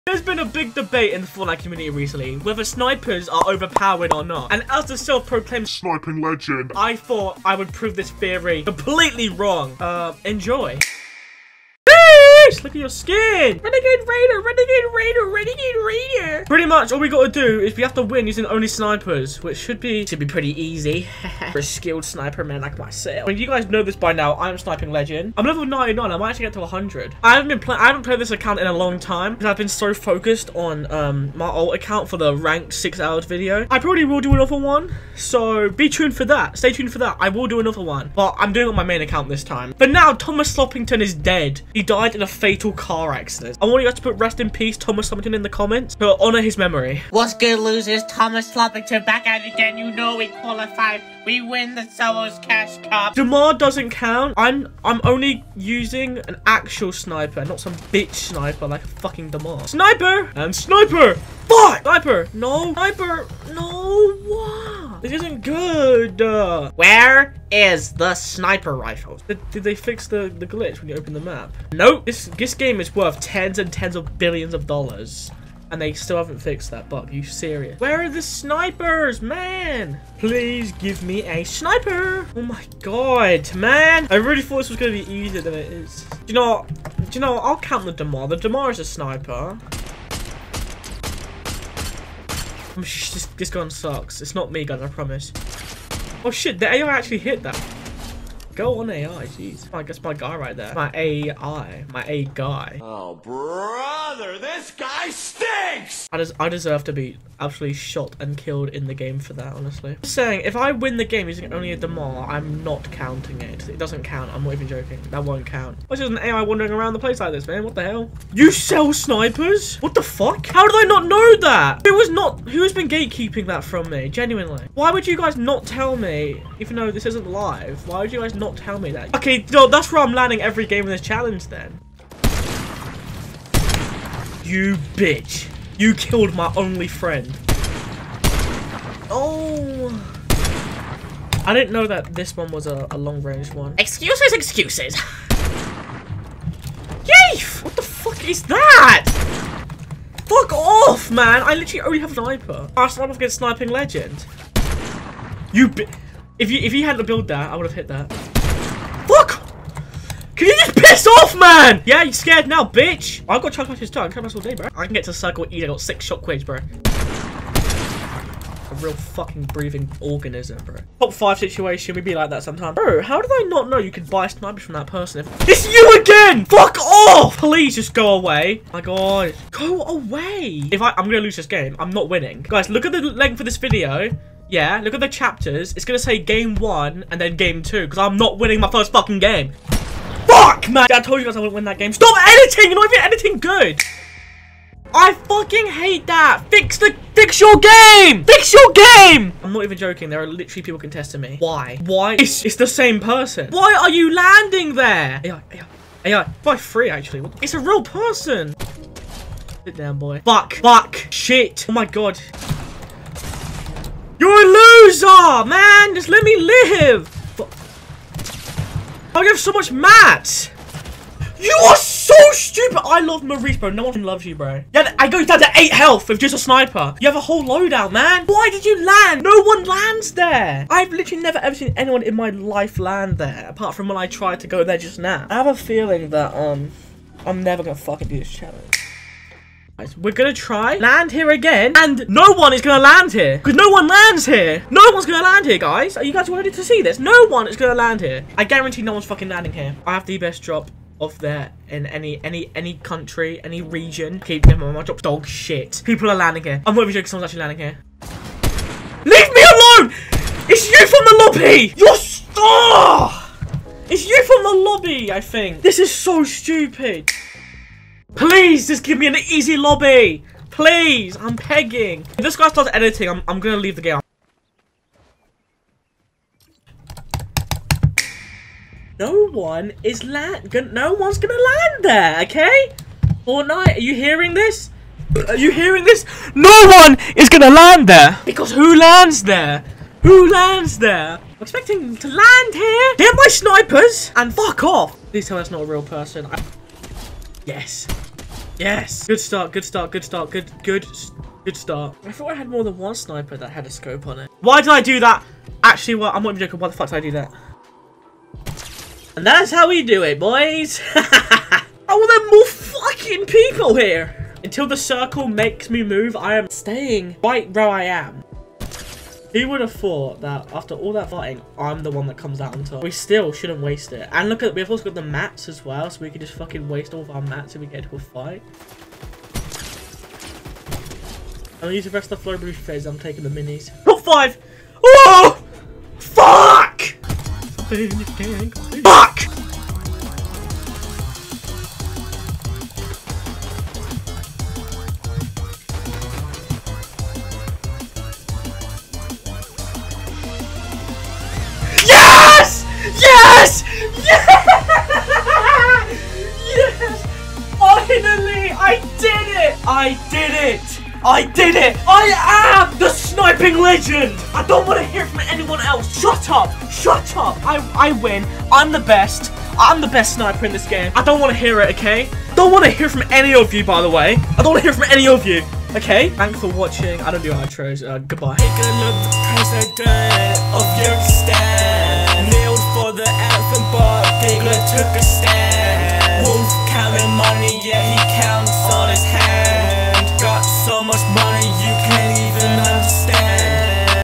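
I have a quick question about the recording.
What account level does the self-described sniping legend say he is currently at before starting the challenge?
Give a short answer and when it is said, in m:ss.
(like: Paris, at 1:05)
99, at 0:25.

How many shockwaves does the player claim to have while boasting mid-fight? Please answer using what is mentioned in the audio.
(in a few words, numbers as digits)
6.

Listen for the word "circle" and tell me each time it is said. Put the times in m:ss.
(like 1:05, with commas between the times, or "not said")
2:45, 5:14.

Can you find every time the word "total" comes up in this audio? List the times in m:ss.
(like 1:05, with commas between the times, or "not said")
not said.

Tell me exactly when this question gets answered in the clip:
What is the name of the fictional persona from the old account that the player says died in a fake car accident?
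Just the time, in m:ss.
0:40.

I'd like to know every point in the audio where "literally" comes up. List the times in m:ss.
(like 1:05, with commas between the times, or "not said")
2:31, 3:20, 3:50.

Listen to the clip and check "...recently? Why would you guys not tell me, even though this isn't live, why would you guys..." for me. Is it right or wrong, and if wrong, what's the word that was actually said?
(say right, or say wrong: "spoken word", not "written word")
wrong: "genuinely", not "recently".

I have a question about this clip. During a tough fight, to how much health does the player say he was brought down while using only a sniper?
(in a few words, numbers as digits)
8.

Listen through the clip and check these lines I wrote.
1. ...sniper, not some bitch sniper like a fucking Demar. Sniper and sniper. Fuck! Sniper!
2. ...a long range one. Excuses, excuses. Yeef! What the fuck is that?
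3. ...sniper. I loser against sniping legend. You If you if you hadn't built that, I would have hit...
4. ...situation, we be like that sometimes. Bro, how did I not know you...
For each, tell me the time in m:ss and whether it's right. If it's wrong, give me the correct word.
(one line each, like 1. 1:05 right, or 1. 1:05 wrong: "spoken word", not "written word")
1. 0:56 right
2. 2:22 right
3. 2:32 wrong: "sniper", not "loser"
4. 2:51 right.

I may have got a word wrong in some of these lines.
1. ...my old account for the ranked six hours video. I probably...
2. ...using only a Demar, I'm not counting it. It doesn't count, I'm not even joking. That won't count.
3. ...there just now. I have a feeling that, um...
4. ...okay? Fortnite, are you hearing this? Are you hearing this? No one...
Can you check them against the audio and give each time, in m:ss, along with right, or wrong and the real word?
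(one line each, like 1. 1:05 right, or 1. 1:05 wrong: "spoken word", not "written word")
1. 0:31 right
2. 1:51 right
3. 3:54 right
4. 4:42 right.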